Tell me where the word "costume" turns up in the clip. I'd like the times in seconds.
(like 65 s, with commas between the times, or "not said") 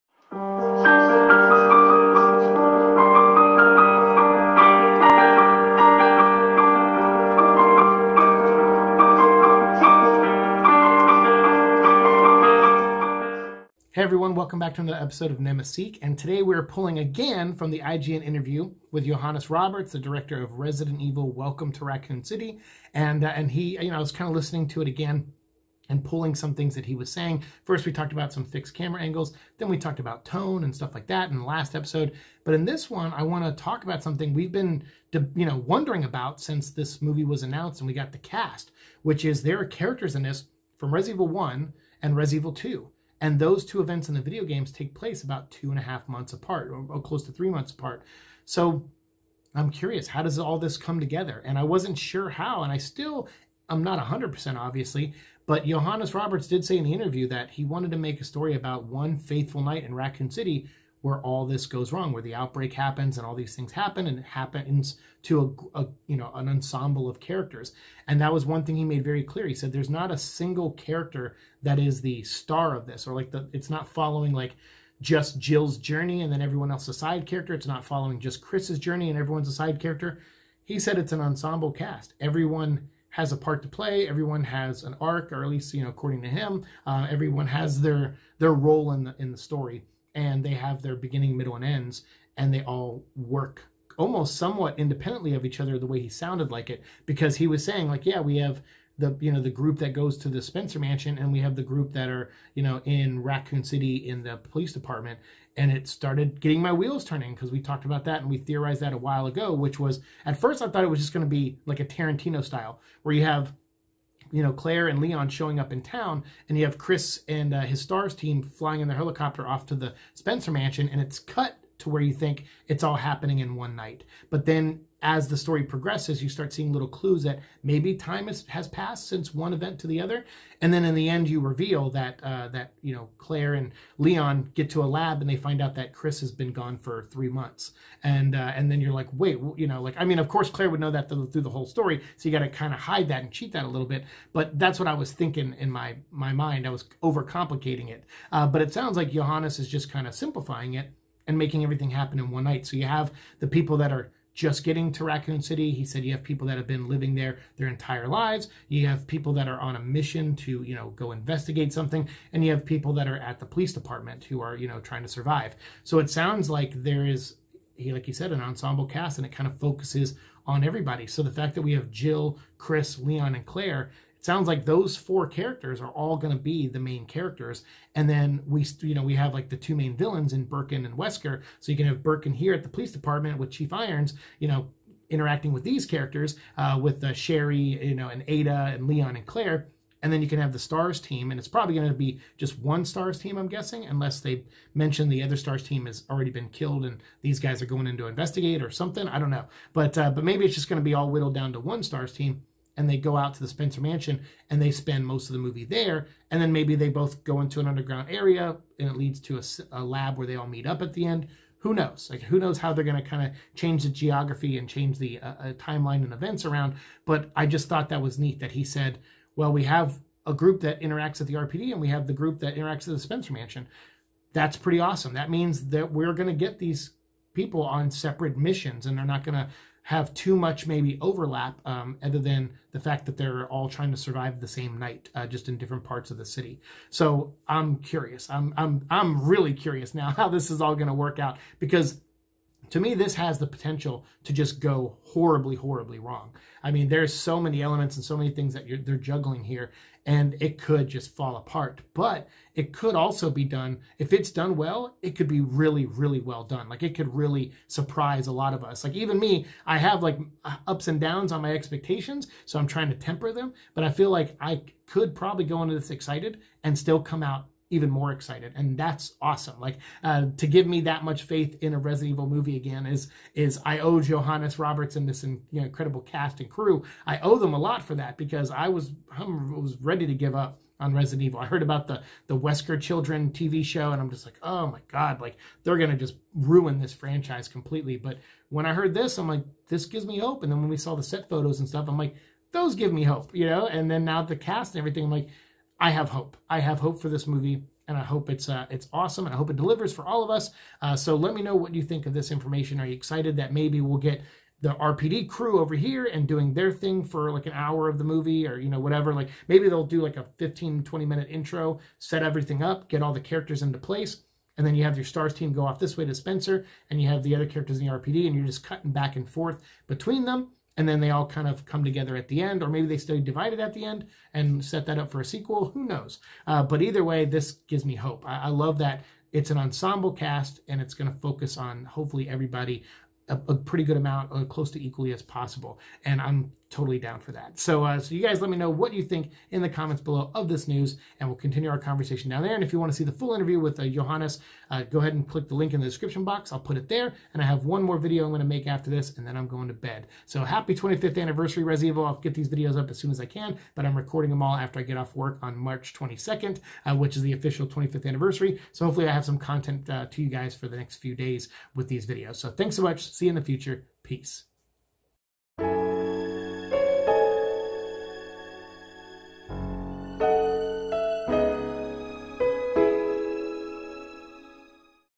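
not said.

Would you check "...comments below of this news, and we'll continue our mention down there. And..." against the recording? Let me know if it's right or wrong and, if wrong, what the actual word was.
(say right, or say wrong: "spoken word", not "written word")
wrong: "conversation", not "mention".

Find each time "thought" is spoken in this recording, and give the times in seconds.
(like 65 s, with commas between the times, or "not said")
110 s, 217 s.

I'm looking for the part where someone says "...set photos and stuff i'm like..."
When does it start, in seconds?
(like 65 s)
291 s.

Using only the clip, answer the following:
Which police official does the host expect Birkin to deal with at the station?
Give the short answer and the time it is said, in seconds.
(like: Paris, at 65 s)
Chief Irons, at 183 s.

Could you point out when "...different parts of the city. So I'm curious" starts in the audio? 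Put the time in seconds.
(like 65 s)
235 s.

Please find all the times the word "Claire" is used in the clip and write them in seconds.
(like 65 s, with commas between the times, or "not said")
114 s, 133 s, 140 s, 173 s, 189 s.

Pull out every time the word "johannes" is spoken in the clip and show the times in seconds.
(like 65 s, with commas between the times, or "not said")
19 s, 55 s, 149 s, 273 s, 343 s.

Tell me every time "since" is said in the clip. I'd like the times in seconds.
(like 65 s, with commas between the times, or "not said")
36 s, 129 s.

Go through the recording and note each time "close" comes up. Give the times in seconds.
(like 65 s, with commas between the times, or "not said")
47 s, 334 s.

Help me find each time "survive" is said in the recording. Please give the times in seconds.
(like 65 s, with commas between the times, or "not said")
165 s, 233 s.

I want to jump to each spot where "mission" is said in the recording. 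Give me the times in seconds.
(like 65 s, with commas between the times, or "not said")
159 s, 228 s.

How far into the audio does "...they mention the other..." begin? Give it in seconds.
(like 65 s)
194 s.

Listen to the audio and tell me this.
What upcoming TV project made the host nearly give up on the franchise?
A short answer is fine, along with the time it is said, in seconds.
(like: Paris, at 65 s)
the Wesker children TV show, at 282 s.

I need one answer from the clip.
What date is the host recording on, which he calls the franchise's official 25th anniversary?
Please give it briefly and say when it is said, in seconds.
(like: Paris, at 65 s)
March 22nd, at 355 s.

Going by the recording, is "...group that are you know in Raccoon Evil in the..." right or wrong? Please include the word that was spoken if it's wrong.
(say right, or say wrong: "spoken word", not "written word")
wrong: "City", not "Evil".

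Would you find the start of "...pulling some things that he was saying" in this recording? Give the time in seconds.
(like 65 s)
26 s.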